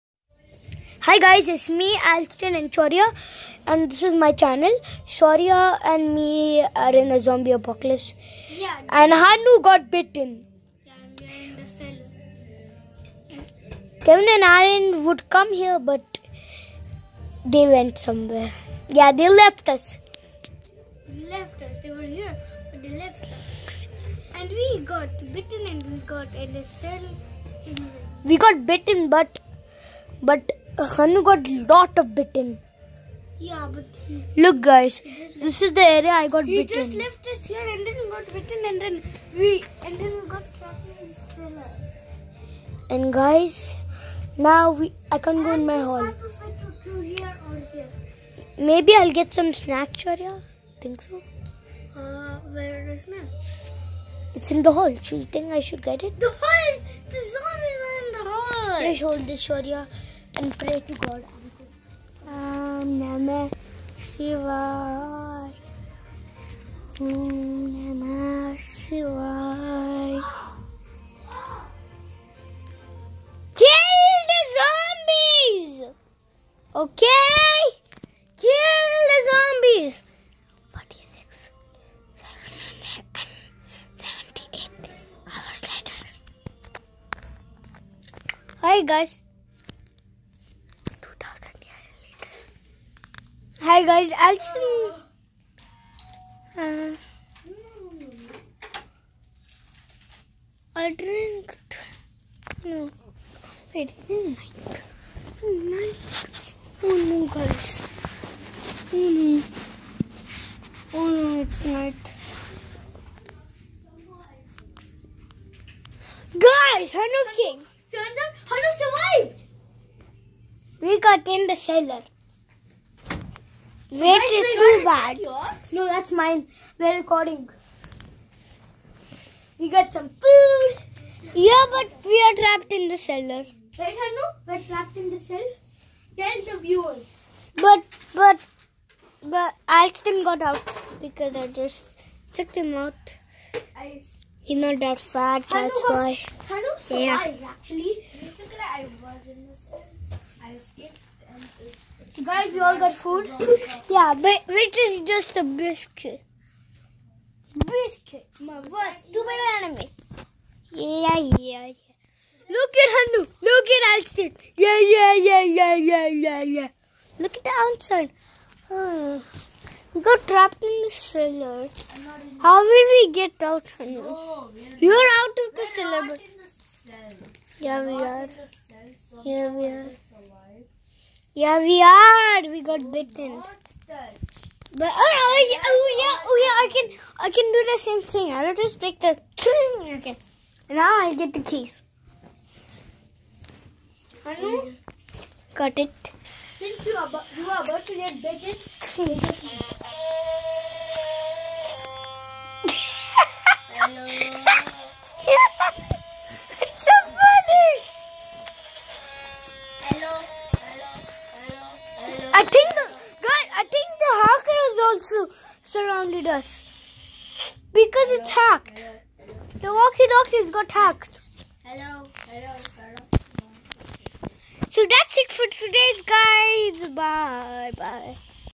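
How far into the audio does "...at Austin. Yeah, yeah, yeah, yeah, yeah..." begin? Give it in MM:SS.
02:43.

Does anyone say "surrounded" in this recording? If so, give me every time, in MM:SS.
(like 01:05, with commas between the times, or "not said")
03:35.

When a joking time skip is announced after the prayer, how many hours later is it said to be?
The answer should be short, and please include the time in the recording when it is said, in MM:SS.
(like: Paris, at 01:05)
46,778 hours, at 01:20.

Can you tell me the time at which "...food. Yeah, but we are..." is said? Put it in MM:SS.
02:10.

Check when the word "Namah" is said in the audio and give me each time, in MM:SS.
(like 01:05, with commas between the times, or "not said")
01:02, 01:06.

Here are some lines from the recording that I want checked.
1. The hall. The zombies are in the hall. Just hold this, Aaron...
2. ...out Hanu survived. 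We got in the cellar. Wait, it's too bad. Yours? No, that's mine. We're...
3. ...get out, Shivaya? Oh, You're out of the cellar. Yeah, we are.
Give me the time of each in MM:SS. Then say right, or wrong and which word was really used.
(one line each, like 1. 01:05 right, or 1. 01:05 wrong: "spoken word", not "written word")
1. 00:56 wrong: "Shorya", not "Aaron"
2. 01:58 right
3. 02:53 wrong: "Hanu", not "Shivaya".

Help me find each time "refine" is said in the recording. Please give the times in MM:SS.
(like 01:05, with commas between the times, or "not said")
not said.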